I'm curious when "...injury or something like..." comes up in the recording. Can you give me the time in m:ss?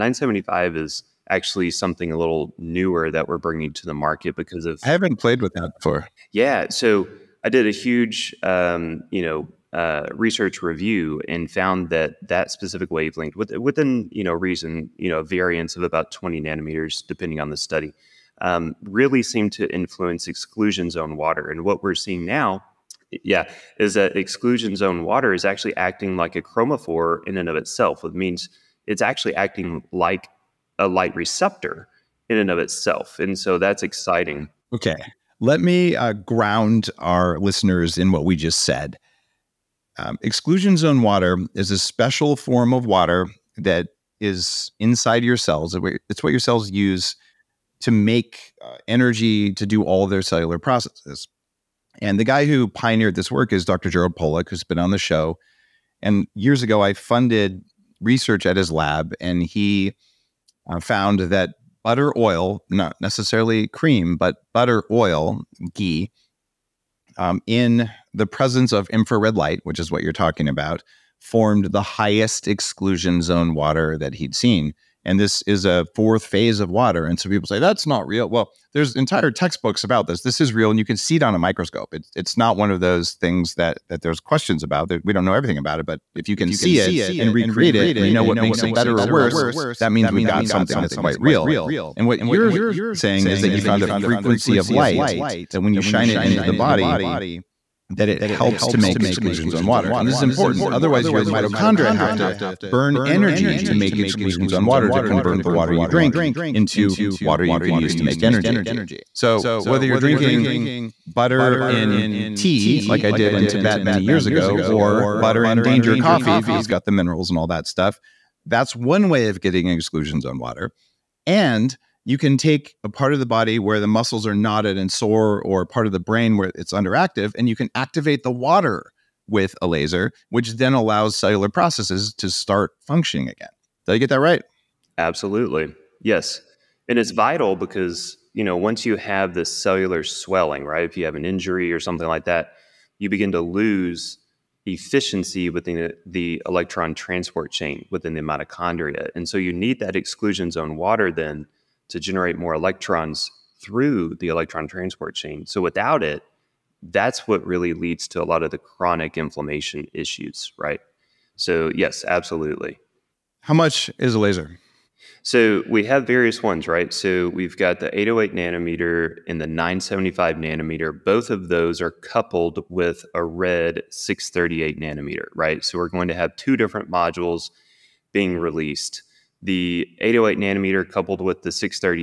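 2:21.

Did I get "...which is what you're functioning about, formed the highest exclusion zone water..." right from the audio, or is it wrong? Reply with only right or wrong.
wrong.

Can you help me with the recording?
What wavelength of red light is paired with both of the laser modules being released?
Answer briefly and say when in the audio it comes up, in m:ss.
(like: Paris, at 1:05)
638 nanometers, at 2:53.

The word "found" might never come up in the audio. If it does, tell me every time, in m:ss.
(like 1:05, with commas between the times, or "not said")
0:11, 1:00, 1:33.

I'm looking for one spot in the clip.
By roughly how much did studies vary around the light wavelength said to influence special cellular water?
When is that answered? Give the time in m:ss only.
0:16.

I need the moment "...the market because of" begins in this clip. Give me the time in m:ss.
0:03.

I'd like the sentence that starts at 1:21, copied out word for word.
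It's it's not one of those things that that there's questions about.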